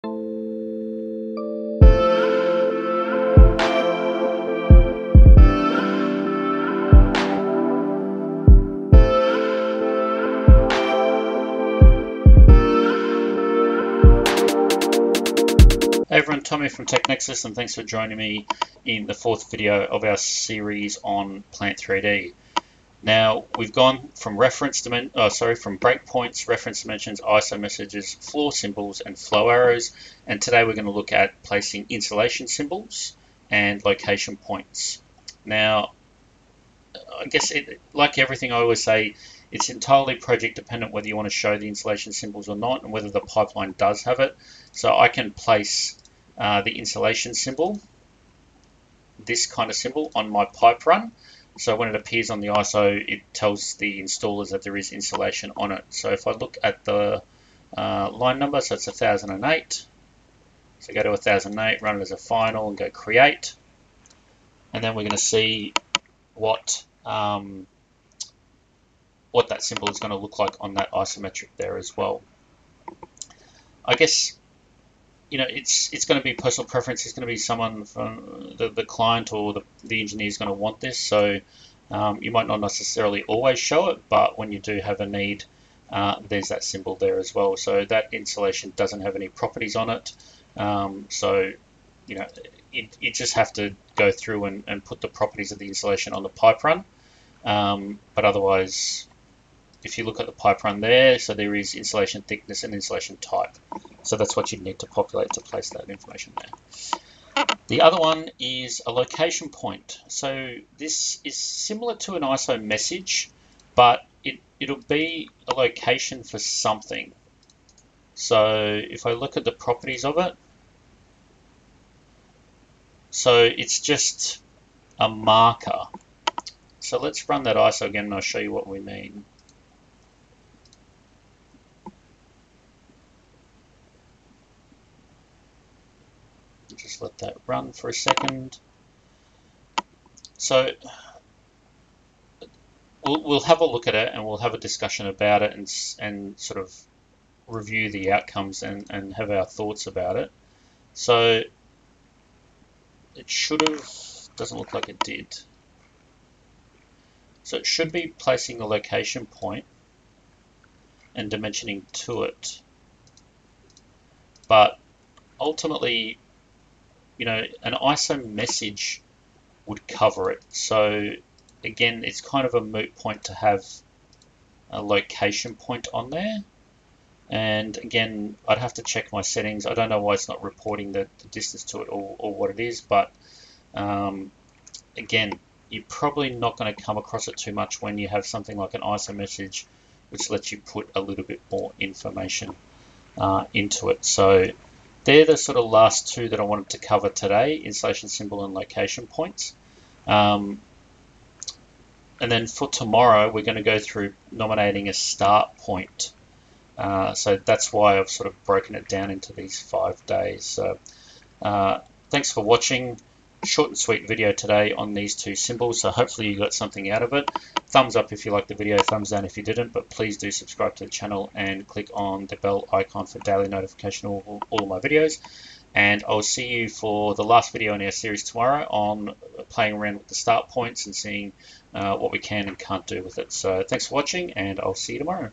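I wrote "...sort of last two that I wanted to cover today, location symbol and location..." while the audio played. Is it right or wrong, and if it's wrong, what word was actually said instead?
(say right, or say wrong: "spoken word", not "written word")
wrong: "insulation", not "location".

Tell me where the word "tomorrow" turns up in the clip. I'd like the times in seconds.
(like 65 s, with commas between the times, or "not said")
202 s, 228 s, 234 s.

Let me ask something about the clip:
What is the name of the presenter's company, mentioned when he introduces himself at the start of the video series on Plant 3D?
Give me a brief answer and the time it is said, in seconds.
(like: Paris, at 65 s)
TechNexus, at 16 s.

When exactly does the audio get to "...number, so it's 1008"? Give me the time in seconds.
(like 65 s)
58 s.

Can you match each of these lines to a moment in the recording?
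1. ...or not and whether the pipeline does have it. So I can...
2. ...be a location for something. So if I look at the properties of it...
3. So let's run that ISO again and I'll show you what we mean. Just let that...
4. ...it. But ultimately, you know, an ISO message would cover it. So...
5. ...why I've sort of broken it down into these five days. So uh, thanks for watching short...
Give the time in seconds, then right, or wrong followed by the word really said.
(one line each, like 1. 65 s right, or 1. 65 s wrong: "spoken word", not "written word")
1. 42 s right
2. 114 s right
3. 126 s right
4. 162 s right
5. 207 s right.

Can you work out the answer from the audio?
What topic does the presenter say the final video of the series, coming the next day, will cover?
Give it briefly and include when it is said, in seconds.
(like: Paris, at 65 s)
Nominating a start point, at 204 s.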